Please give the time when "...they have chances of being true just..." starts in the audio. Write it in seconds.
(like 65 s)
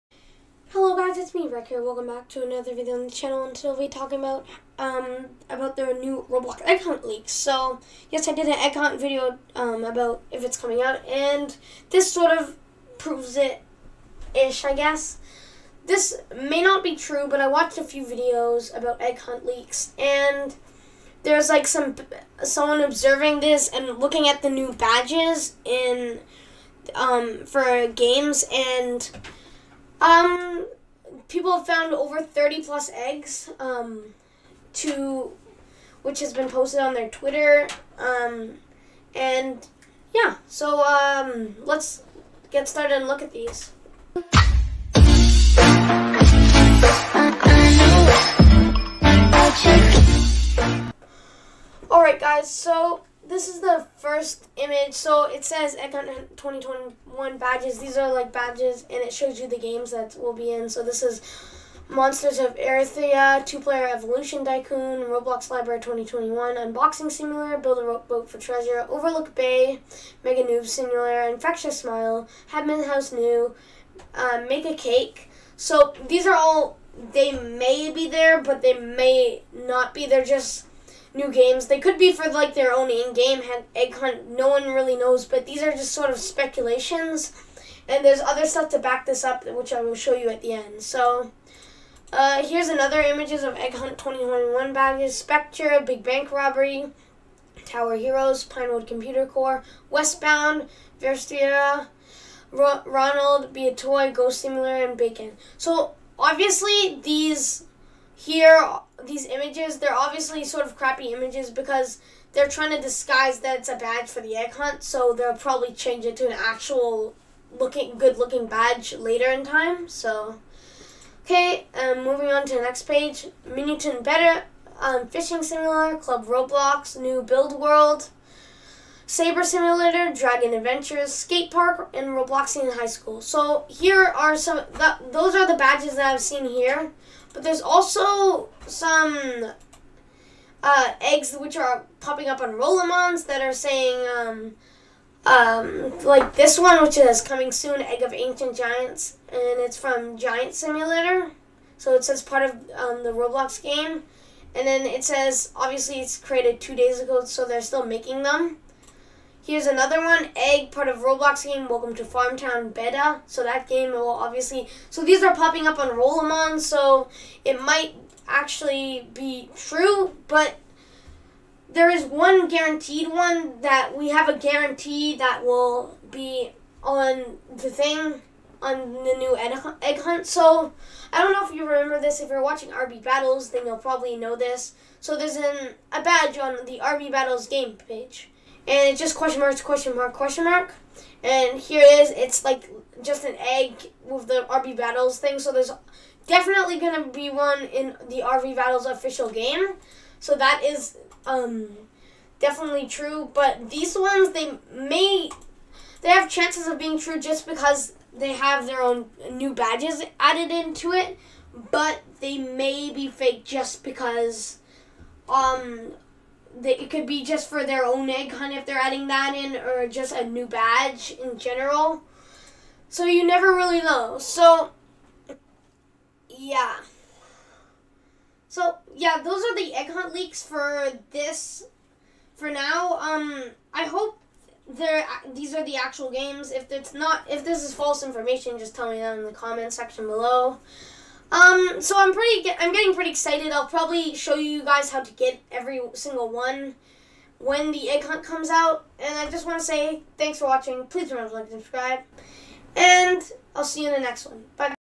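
206 s.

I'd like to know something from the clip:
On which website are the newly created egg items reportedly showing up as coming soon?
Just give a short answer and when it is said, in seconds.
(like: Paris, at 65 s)
Rolimons, at 142 s.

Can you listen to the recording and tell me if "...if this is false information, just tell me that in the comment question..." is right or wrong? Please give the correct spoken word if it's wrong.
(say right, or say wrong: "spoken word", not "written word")
wrong: "section", not "question".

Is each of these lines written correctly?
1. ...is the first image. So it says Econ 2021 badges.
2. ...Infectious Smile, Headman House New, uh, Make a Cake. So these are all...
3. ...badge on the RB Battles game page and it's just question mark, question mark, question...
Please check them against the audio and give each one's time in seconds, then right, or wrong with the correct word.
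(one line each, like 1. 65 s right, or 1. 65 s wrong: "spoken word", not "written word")
1. 53 s right
2. 71 s right
3. 186 s right.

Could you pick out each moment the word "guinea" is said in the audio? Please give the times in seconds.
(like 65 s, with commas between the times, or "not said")
not said.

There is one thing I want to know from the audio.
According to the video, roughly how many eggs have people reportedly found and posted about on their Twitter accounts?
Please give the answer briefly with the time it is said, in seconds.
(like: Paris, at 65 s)
30 plus, at 31 s.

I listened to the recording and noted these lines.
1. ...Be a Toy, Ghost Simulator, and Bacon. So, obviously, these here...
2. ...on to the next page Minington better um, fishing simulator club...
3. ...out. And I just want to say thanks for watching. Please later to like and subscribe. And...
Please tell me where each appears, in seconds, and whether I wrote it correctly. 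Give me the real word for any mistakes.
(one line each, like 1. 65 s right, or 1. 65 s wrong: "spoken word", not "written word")
1. 103 s right
2. 122 s right
3. 248 s wrong: "remember", not "later".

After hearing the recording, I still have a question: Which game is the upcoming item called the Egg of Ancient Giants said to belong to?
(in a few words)
Giant Simulator.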